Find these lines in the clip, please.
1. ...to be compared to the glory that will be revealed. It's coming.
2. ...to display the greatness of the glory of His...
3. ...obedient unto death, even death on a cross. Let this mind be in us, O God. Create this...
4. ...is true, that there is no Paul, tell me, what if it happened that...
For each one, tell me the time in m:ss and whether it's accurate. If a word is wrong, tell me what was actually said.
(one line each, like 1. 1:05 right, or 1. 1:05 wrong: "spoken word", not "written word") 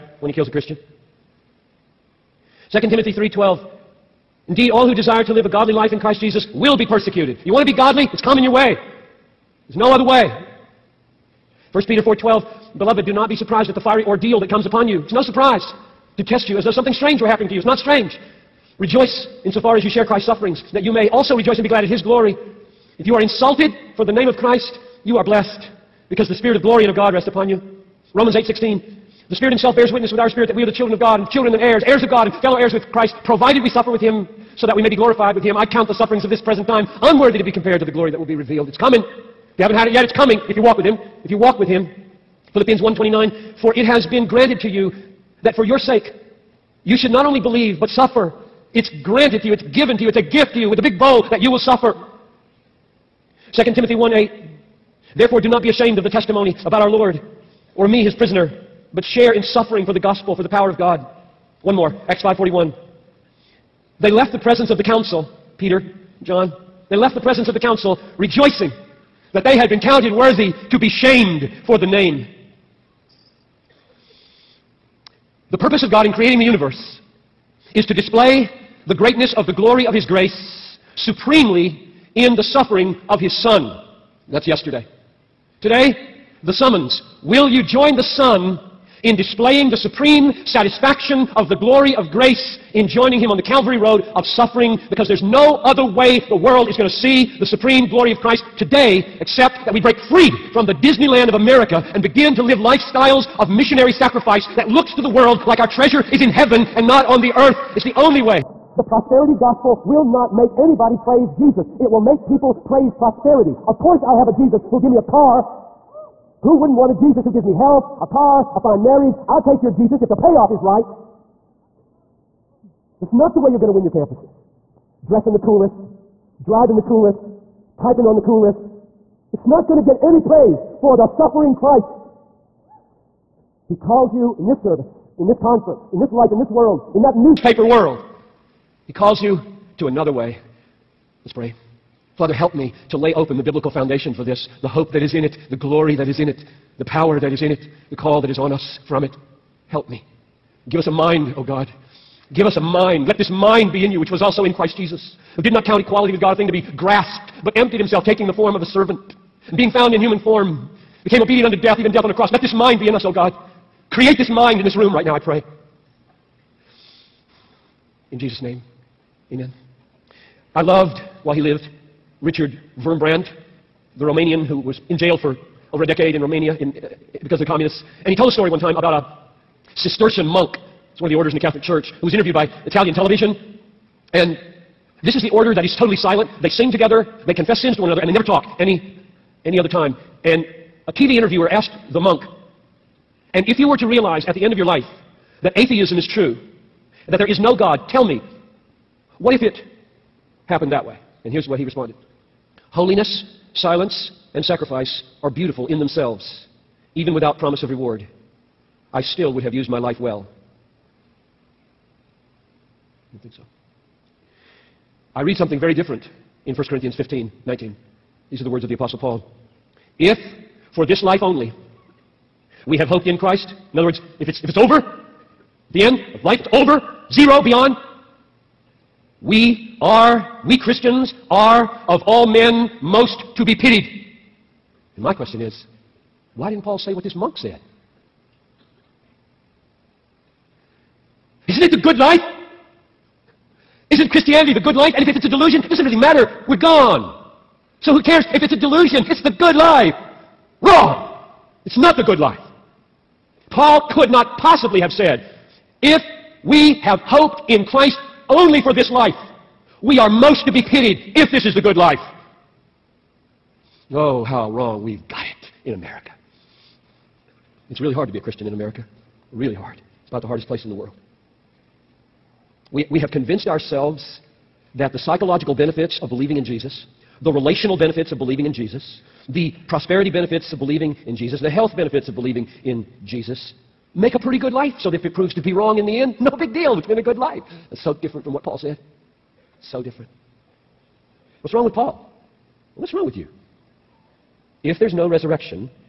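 1. 0:37 right
2. 1:17 right
3. 2:41 right
4. 3:15 wrong: "God", not "Paul".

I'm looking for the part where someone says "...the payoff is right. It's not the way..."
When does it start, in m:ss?
2:00.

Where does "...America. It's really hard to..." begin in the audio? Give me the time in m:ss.
4:25.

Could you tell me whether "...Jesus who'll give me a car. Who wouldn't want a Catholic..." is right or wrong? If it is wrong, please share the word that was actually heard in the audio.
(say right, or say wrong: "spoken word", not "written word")
wrong: "Jesus", not "Catholic".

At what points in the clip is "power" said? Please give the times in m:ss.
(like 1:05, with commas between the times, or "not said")
1:00, 2:26.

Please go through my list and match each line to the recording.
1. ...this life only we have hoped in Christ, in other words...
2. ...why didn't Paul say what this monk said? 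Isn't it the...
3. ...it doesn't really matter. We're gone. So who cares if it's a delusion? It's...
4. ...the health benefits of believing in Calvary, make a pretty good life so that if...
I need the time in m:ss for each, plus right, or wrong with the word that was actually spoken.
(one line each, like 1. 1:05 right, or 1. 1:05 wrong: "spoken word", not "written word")
1. 3:40 right
2. 3:56 right
3. 4:05 right
4. 4:41 wrong: "Jesus", not "Calvary".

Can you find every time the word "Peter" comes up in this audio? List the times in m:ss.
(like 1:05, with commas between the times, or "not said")
0:11, 1:05.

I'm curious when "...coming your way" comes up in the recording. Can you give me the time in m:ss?
0:08.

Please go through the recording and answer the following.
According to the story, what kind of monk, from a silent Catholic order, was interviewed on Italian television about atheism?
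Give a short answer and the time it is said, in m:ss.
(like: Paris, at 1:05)
Cistercian, at 2:59.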